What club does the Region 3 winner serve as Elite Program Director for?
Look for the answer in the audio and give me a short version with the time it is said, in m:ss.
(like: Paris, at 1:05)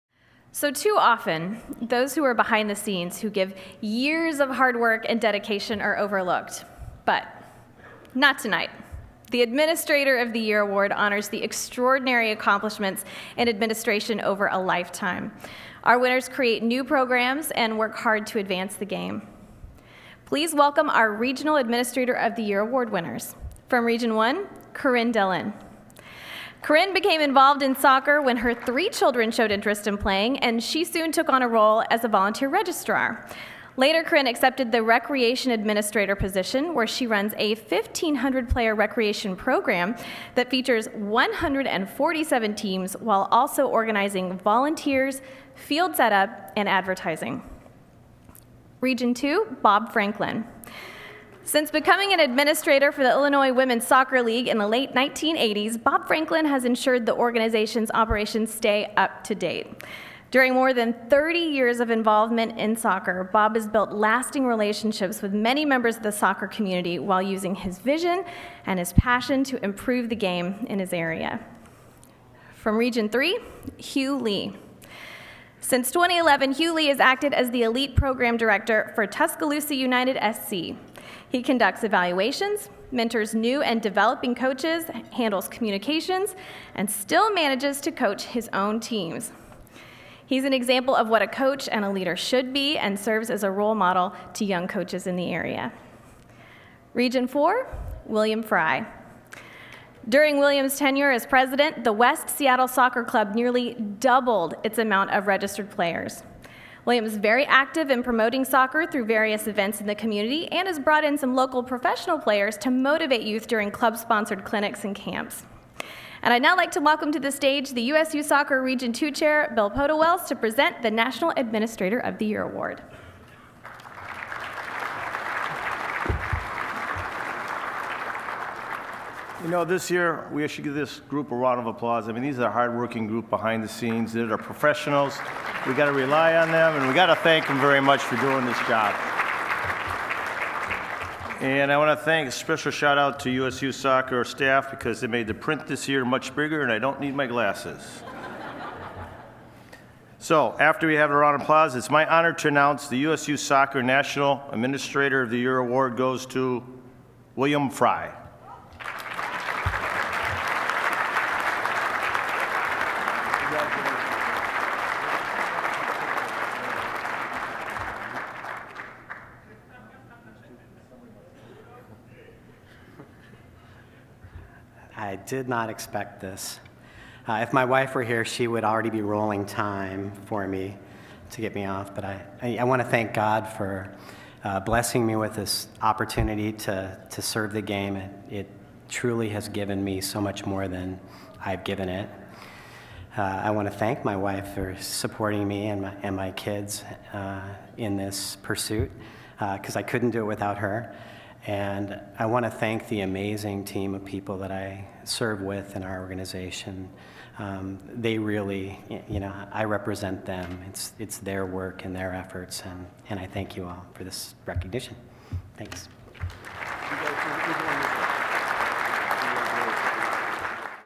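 Tuscaloosa United SC, at 1:19.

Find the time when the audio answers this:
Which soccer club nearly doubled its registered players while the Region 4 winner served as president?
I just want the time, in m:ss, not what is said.
1:41.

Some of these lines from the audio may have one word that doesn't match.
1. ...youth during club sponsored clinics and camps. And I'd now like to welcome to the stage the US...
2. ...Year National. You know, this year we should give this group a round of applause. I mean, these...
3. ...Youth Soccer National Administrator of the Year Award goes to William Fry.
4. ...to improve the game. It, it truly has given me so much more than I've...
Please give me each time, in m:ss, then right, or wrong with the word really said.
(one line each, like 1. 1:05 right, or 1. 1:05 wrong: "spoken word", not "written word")
1. 1:53 right
2. 2:02 wrong: "Award", not "National"
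3. 2:33 right
4. 3:07 wrong: "serve", not "improve".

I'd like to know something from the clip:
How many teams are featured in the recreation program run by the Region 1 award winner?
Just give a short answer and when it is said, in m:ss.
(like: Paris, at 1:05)
147, at 0:40.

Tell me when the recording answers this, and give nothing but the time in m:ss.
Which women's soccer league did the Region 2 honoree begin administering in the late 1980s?
0:53.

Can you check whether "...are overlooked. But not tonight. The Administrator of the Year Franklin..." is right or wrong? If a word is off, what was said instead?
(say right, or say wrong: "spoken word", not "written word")
wrong: "Award", not "Franklin".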